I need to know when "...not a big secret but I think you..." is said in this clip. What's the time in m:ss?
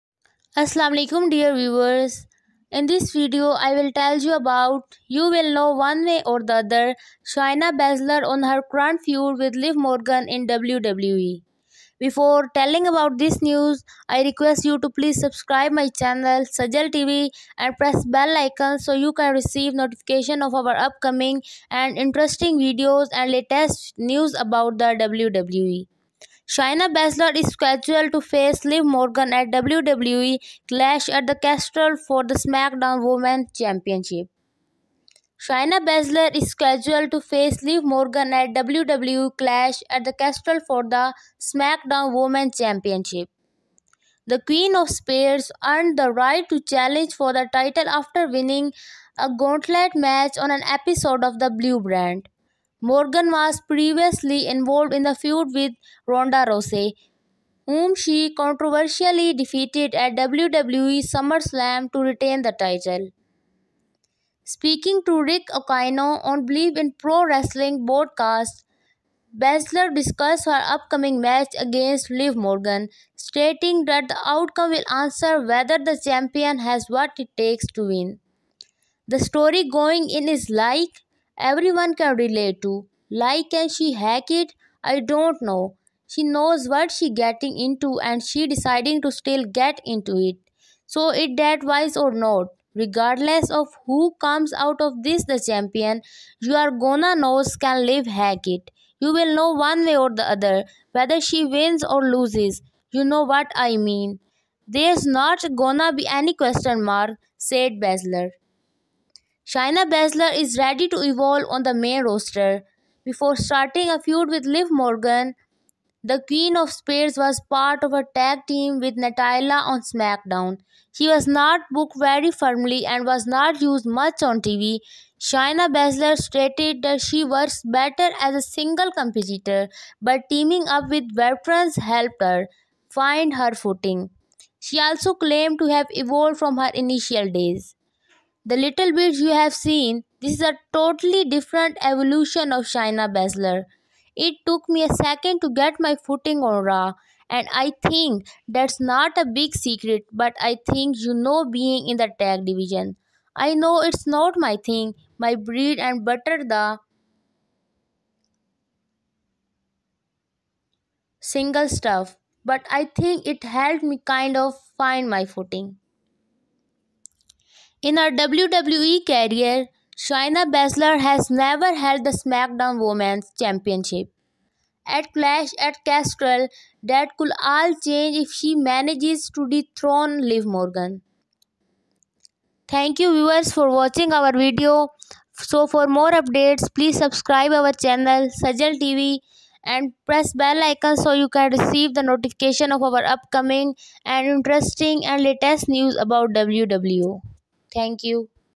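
2:28.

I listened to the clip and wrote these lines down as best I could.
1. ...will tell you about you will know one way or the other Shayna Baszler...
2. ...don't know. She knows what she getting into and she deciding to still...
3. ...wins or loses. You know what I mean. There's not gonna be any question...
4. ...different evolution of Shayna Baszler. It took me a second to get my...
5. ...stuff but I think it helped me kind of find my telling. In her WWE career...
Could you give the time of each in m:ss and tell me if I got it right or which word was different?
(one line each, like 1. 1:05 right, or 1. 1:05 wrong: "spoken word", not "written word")
1. 0:03 right
2. 1:24 right
3. 1:41 right
4. 2:21 right
5. 2:41 wrong: "footing", not "telling".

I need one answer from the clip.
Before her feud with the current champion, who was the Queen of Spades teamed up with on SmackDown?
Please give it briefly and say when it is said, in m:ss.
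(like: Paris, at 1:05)
Natalya, at 1:58.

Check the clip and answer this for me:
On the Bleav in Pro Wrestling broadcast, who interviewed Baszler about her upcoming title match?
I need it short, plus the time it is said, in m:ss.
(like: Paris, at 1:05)
Rick Ucchino, at 1:05.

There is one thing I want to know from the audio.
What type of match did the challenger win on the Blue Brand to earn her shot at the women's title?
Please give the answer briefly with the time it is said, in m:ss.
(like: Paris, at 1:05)
gauntlet match, at 0:49.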